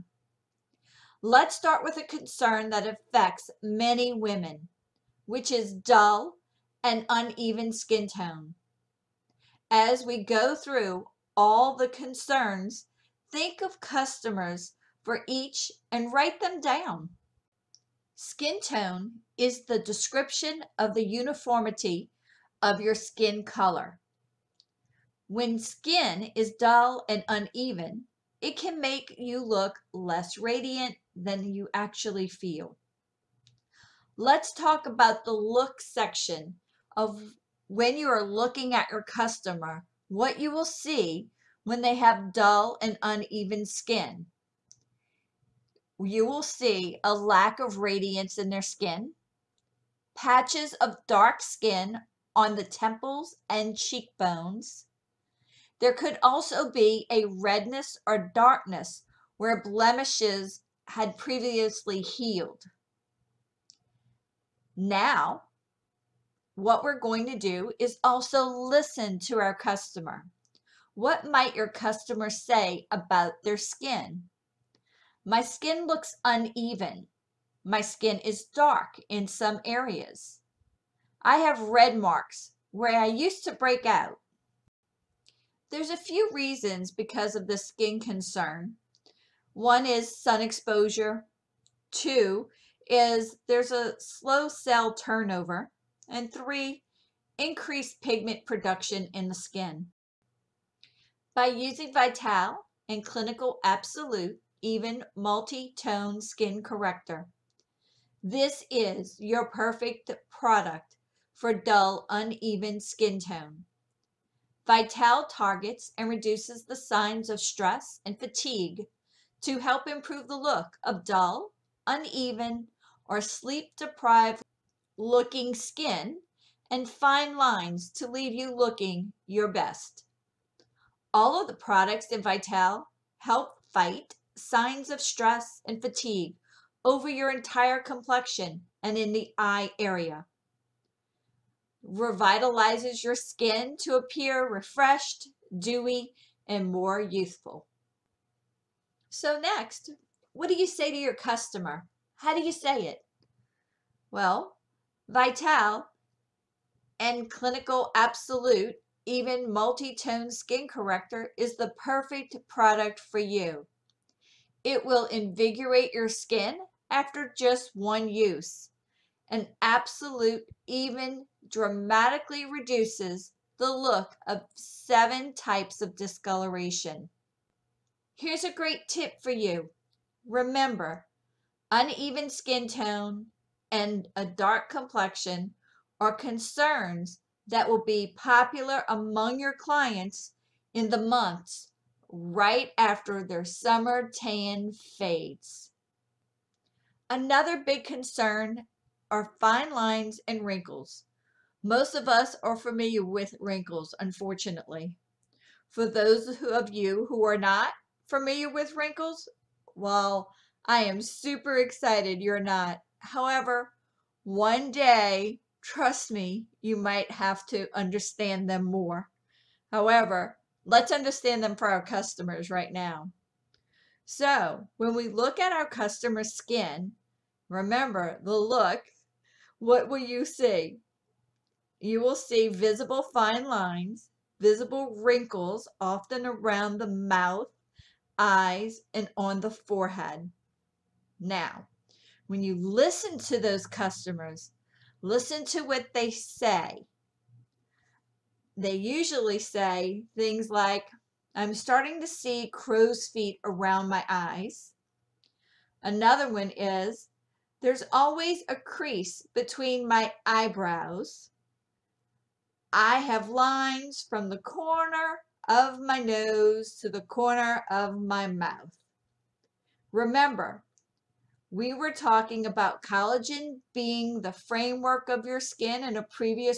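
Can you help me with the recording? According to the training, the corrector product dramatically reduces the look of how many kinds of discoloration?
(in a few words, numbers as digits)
7.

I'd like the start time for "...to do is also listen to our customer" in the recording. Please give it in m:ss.
1:07.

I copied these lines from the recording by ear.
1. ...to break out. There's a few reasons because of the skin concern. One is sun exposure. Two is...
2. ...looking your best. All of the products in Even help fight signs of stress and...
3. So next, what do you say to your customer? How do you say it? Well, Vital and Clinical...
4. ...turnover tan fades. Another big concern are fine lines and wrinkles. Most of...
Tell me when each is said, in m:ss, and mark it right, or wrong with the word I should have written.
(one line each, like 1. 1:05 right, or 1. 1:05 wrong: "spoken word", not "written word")
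1. 1:23 right
2. 2:08 wrong: "Vital", not "Even"
3. 2:29 right
4. 3:13 wrong: "summer", not "turnover".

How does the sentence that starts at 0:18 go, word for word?
Skin tone is the description of the uniformity of your skin color.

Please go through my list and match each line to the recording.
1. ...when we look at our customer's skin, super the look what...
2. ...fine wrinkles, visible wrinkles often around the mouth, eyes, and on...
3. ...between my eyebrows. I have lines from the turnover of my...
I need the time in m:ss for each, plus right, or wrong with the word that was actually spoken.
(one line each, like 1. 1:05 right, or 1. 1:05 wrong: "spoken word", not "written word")
1. 3:44 wrong: "remember", not "super"
2. 3:53 wrong: "lines", not "wrinkles"
3. 4:19 wrong: "corner", not "turnover".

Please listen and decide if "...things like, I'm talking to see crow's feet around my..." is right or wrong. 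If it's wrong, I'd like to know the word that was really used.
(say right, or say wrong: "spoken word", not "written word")
wrong: "starting", not "talking".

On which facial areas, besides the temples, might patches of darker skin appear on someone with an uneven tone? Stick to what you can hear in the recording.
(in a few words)
cheekbones.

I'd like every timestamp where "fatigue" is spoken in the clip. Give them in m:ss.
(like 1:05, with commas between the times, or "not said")
1:58, 2:15.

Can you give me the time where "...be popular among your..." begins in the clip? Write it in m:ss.
3:07.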